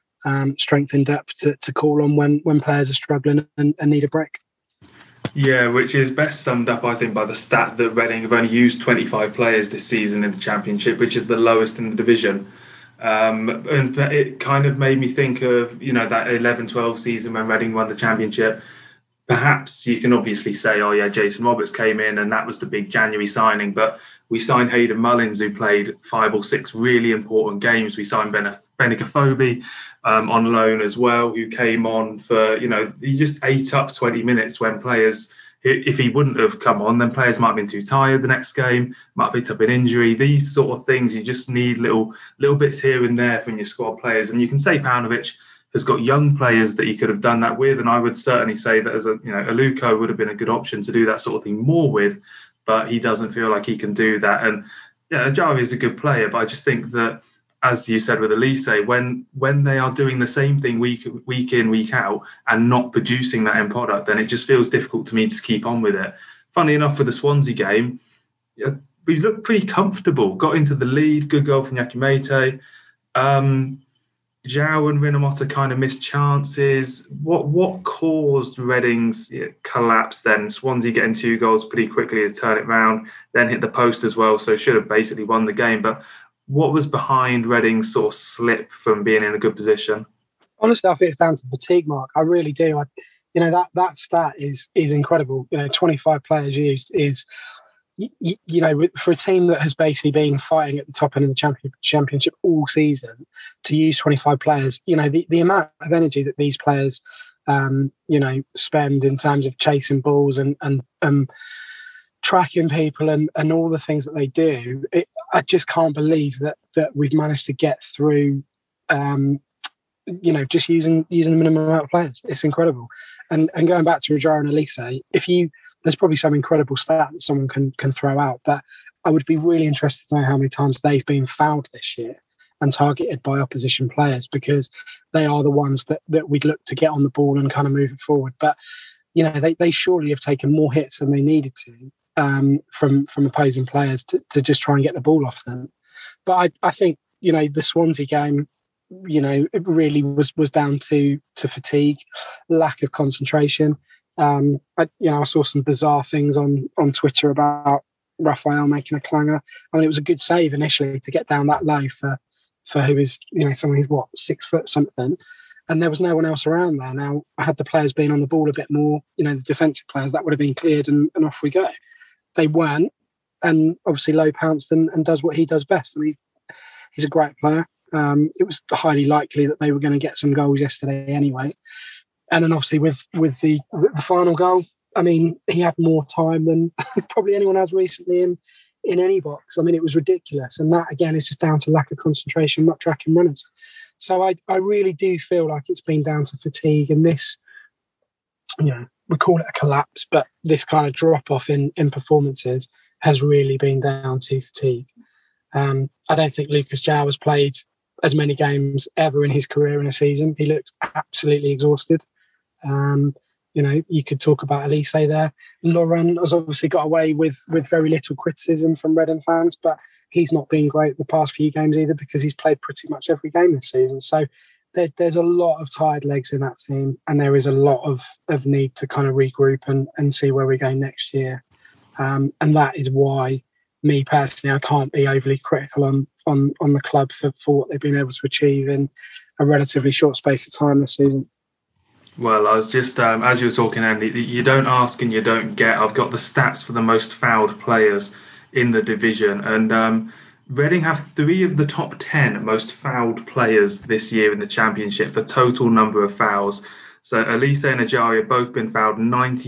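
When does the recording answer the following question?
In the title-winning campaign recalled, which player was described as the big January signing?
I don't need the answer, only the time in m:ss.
0:21.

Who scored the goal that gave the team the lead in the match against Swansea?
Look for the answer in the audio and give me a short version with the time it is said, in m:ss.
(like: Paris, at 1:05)
Yakou Méïté, at 1:11.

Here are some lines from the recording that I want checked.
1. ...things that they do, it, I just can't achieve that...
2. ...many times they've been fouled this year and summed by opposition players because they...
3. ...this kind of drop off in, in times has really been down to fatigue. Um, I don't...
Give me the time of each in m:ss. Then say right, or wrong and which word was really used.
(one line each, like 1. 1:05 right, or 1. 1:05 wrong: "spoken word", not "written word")
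1. 1:53 wrong: "believe", not "achieve"
2. 2:10 wrong: "targeted", not "summed"
3. 3:20 wrong: "performances", not "times".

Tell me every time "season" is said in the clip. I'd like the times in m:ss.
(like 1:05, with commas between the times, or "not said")
0:09, 0:16, 1:42, 3:29, 3:43, 4:00.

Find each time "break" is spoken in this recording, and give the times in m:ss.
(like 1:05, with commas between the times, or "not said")
0:04.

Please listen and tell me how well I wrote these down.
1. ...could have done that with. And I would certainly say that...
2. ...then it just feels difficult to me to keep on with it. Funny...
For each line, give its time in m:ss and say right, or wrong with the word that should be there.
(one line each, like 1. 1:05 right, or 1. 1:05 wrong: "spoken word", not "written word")
1. 0:46 right
2. 1:04 right.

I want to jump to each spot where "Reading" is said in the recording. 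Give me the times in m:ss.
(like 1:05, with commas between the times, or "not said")
0:07, 0:17, 1:18, 1:27, 4:10.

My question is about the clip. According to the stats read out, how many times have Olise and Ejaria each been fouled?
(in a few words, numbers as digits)
92.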